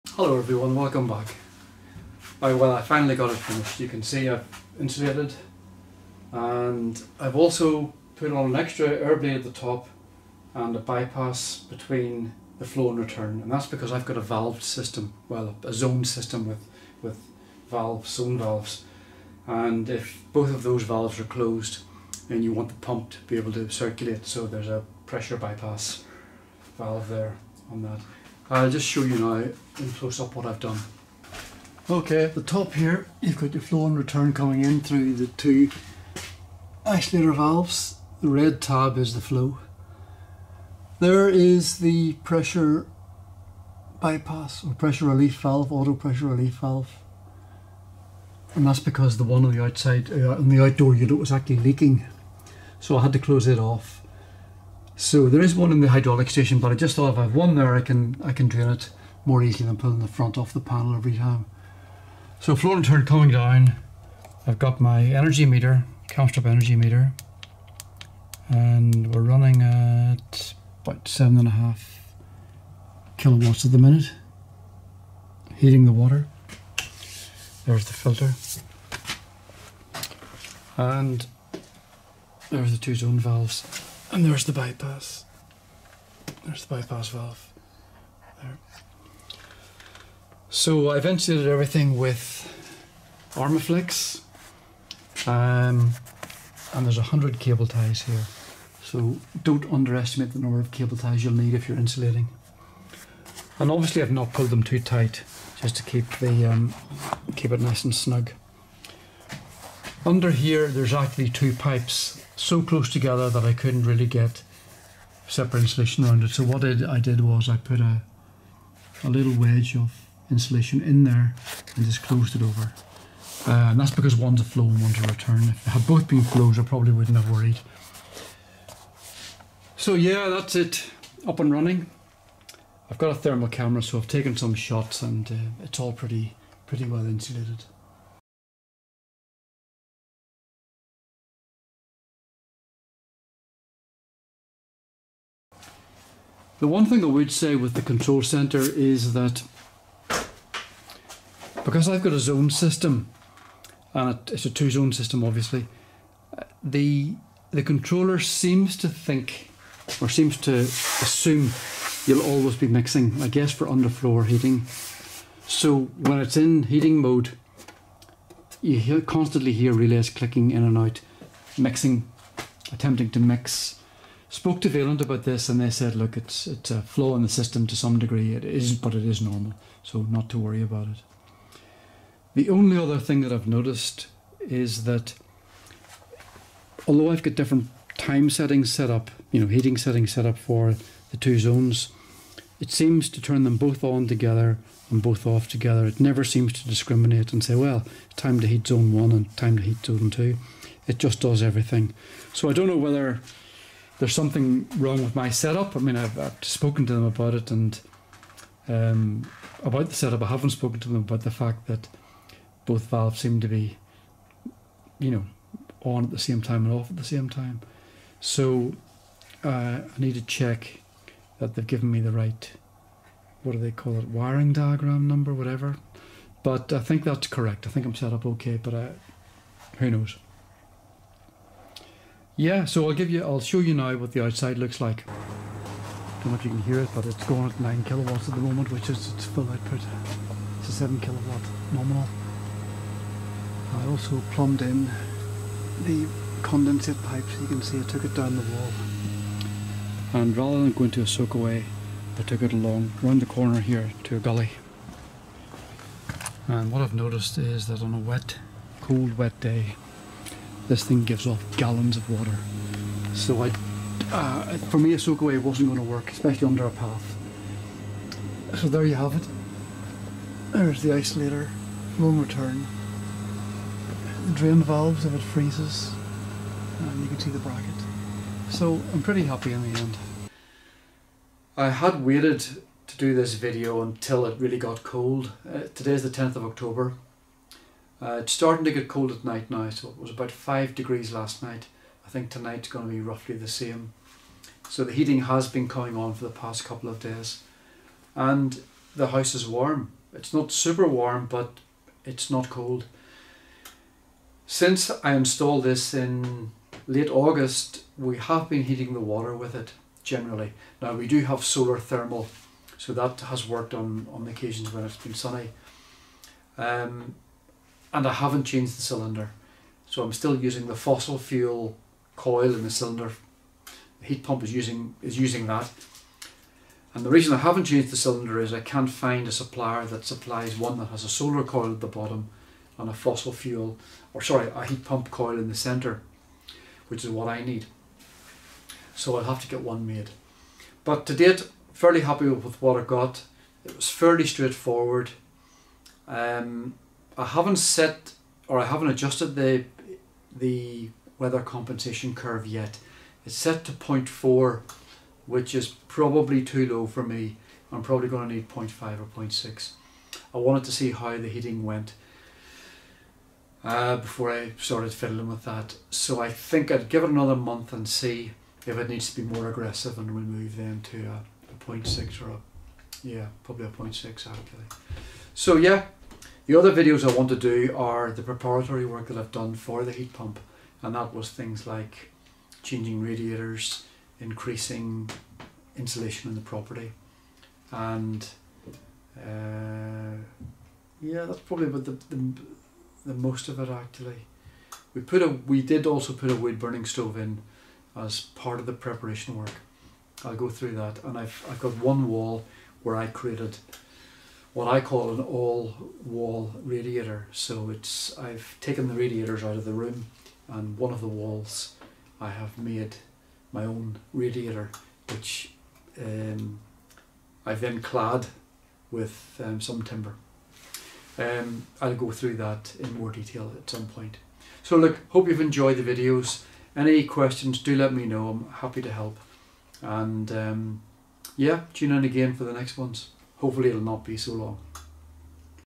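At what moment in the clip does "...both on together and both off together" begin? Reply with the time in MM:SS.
03:13.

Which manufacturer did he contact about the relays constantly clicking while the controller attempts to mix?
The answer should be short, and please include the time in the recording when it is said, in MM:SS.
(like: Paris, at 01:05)
Vaillant, at 02:54.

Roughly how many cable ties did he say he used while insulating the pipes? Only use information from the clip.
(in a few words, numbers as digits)
100.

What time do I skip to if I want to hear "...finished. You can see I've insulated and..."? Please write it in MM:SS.
00:03.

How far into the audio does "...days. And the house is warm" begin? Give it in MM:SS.
04:56.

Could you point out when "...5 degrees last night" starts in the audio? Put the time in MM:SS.
04:50.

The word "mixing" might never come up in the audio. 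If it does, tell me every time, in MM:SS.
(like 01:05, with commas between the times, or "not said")
02:42, 02:51.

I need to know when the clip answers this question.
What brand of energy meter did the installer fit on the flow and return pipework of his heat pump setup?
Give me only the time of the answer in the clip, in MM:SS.
01:06.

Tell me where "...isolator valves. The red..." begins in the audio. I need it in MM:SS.
00:36.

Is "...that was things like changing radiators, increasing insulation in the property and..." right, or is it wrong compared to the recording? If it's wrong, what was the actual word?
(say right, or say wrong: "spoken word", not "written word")
right.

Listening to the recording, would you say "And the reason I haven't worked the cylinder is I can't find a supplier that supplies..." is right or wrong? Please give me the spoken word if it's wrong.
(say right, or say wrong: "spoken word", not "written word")
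wrong: "changed", not "worked".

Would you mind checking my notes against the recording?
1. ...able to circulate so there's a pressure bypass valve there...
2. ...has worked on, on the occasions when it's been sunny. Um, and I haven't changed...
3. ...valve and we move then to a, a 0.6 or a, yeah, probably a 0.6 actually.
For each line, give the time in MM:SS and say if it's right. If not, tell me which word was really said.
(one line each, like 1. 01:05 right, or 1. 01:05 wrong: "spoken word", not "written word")
1. 00:23 right
2. 05:13 right
3. 06:09 wrong: "aggressive", not "valve".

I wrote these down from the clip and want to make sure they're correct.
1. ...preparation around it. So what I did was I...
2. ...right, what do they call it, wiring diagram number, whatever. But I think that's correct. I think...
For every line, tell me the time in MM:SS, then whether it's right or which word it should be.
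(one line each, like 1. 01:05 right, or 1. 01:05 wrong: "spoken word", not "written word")
1. 01:55 wrong: "insulation", not "preparation"
2. 03:42 right.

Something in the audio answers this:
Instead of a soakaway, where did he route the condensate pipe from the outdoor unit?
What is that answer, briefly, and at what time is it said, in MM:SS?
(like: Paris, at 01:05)
a gully, at 04:14.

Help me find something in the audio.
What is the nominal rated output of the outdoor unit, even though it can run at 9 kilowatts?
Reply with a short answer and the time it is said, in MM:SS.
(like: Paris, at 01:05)
7 kilowatts, at 04:00.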